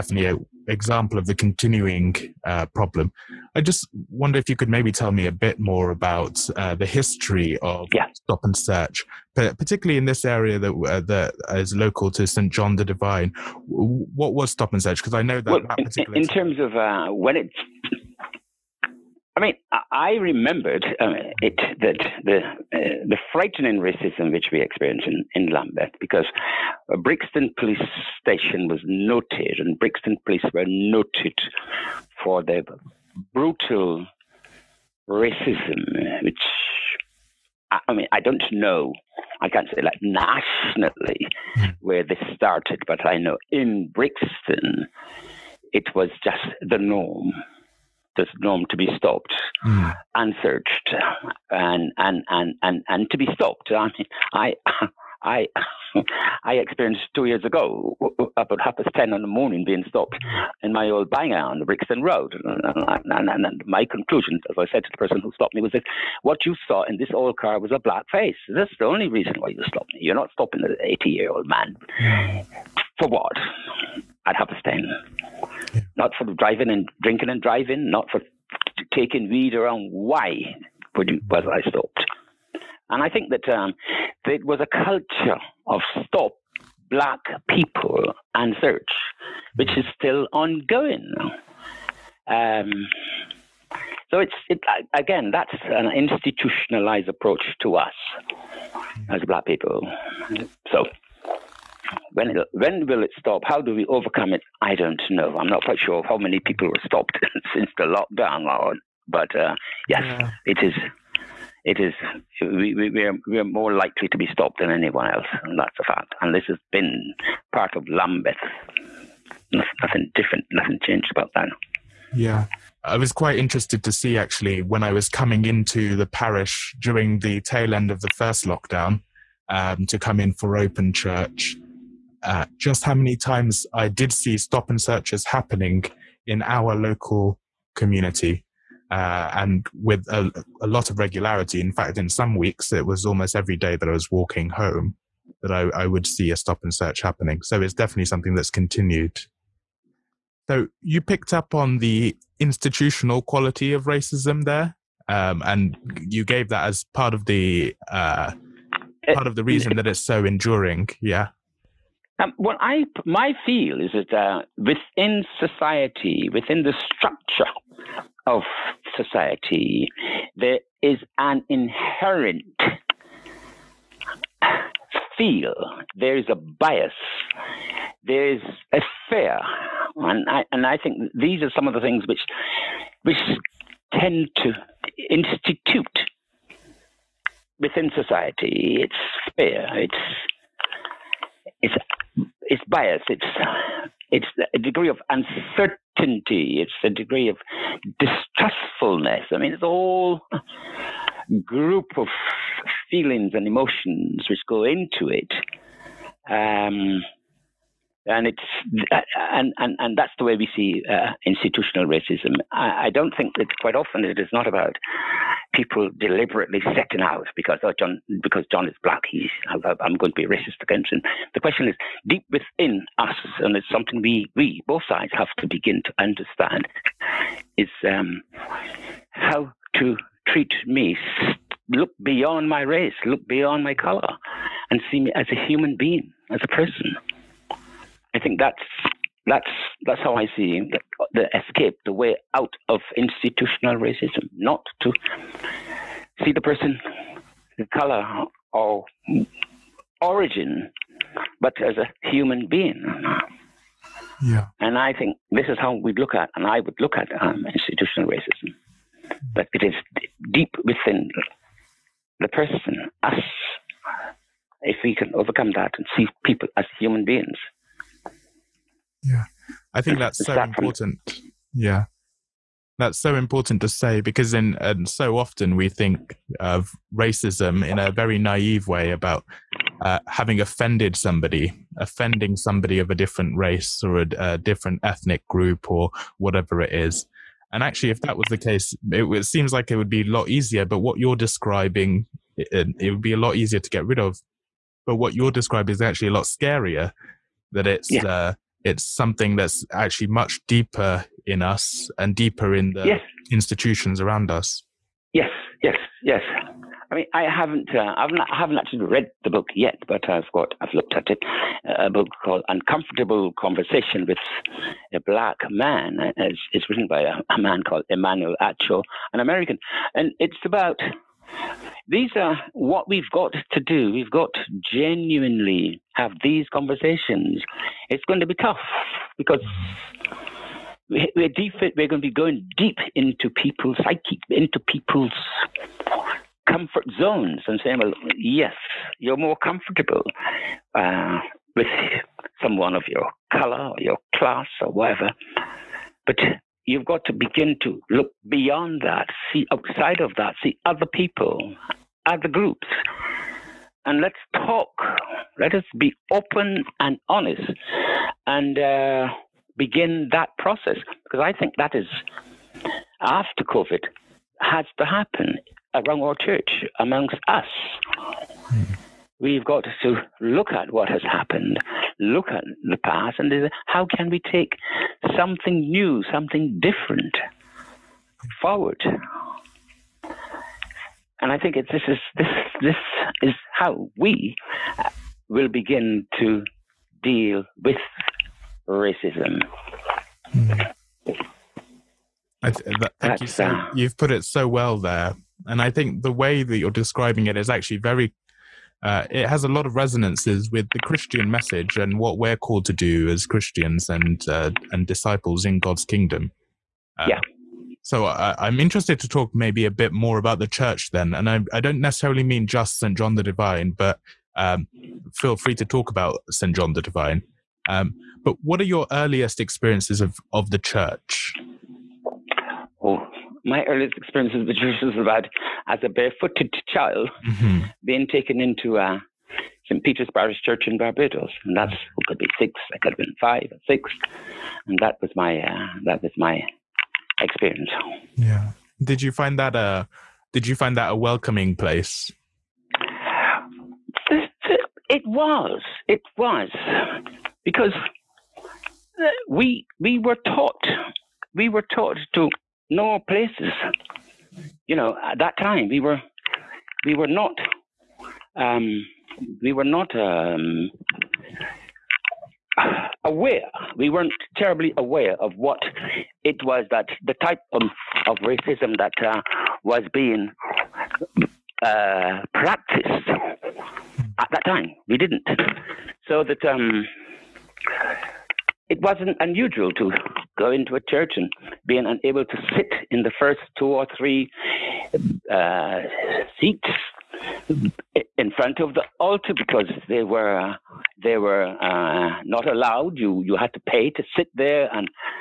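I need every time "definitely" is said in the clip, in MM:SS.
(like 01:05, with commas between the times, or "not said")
02:27.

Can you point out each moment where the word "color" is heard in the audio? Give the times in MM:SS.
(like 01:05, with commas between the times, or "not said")
03:53, 04:07, 05:43.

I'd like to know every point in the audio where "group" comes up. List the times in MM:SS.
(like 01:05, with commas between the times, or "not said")
03:21, 04:45, 05:52.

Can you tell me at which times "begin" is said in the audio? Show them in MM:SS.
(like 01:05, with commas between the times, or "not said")
03:45, 05:47, 05:59, 06:25.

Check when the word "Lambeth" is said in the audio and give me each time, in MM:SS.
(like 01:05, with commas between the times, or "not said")
00:25, 01:57.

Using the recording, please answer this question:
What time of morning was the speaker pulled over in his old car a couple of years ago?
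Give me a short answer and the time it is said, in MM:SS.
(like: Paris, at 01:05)
10:30, at 00:58.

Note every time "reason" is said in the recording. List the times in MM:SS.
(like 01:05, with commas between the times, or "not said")
01:09, 02:39.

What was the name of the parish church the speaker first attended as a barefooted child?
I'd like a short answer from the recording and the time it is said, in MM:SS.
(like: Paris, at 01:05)
St. Peter's Parish Church, at 07:09.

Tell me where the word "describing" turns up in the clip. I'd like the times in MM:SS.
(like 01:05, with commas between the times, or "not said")
04:51, 04:55, 06:36.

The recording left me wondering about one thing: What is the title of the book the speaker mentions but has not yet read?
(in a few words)
Uncomfortable Conversation with a Black Man.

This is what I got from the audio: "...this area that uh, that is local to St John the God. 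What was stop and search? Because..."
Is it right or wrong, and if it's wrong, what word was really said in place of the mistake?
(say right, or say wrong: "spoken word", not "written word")
wrong: "Divine", not "God".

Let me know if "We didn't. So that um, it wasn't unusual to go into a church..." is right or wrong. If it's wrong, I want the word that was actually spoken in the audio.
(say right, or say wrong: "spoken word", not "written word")
right.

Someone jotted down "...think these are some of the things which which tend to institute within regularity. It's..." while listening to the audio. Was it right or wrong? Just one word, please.
wrong.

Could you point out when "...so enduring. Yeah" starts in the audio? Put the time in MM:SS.
02:40.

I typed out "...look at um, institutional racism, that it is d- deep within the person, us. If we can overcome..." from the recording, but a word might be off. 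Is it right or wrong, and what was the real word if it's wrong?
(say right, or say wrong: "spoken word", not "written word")
right.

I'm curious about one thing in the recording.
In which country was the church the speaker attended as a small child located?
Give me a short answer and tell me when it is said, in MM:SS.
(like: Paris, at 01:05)
Barbados, at 07:10.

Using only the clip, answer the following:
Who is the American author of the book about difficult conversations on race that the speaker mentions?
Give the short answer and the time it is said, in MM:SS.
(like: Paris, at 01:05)
Emmanuel Acho, at 05:17.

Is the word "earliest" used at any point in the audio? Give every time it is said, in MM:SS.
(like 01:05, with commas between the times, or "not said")
06:58, 07:03.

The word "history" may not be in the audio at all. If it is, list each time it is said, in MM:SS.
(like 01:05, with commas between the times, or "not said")
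00:06.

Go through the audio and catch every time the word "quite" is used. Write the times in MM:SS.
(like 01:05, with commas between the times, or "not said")
01:45, 02:03, 03:33.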